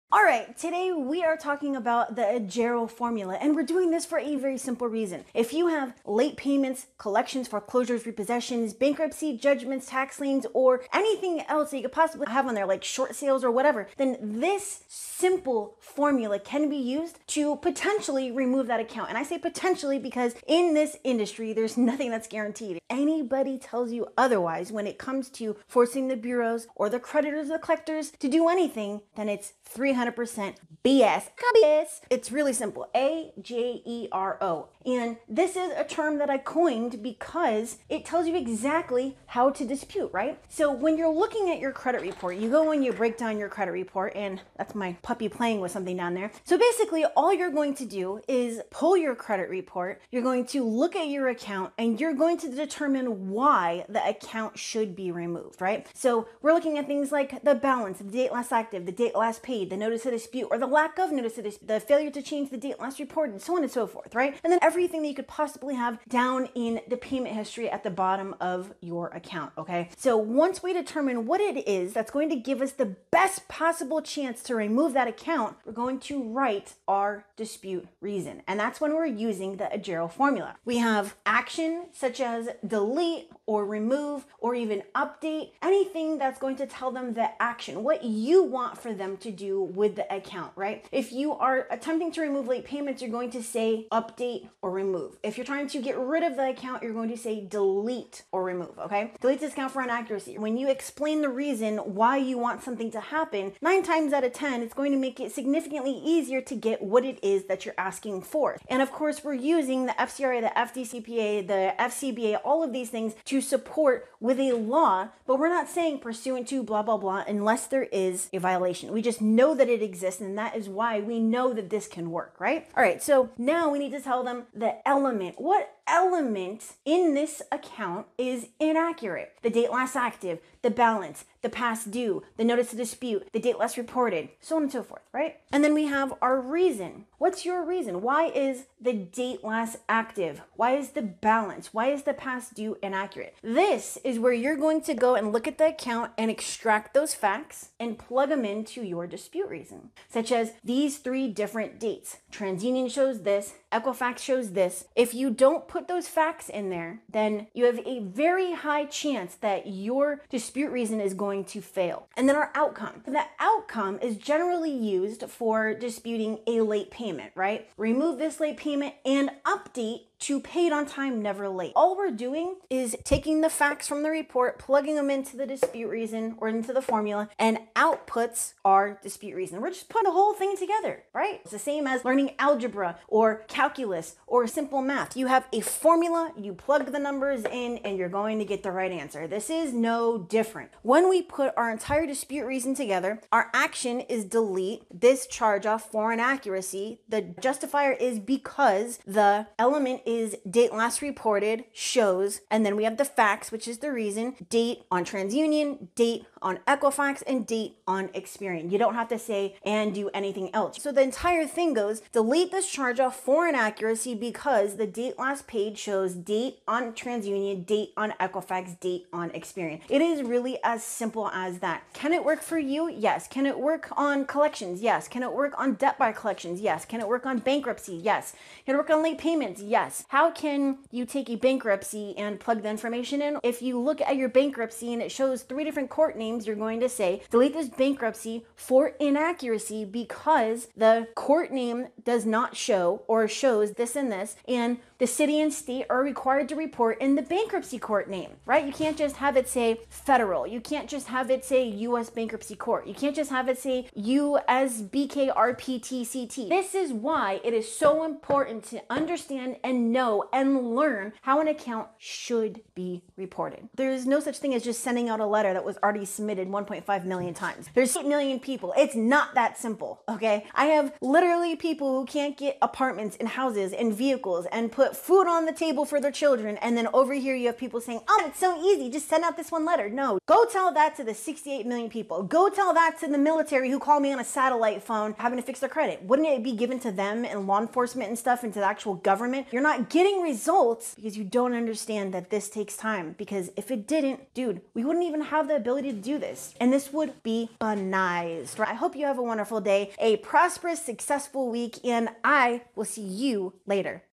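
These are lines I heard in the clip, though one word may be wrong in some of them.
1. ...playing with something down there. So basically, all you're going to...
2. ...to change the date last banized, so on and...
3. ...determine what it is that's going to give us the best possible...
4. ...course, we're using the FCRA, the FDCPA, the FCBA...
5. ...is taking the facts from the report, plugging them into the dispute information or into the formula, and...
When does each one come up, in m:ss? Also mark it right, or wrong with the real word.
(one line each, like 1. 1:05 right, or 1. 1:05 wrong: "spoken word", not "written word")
1. 0:45 right
2. 1:02 wrong: "reported", not "banized"
3. 1:10 right
4. 1:48 right
5. 2:52 wrong: "reason", not "information".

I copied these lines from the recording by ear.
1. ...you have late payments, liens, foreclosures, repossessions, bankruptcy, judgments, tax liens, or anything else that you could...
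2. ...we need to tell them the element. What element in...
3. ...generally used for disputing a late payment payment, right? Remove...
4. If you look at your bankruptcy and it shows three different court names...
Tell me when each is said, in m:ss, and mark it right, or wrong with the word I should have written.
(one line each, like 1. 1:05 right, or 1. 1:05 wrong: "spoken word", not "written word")
1. 0:05 wrong: "collections", not "liens"
2. 2:03 right
3. 2:44 right
4. 3:53 right.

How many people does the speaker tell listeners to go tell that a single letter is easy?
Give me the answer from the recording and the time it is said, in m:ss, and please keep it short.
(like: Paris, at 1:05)
68 million, at 4:41.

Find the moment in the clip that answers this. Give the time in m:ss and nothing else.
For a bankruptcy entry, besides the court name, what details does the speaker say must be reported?
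4:05.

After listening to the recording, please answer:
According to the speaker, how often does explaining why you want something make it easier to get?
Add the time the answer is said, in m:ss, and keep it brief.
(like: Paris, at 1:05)
9 times out of 10, at 1:43.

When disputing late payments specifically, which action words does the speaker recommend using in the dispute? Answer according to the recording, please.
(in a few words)
update or remove.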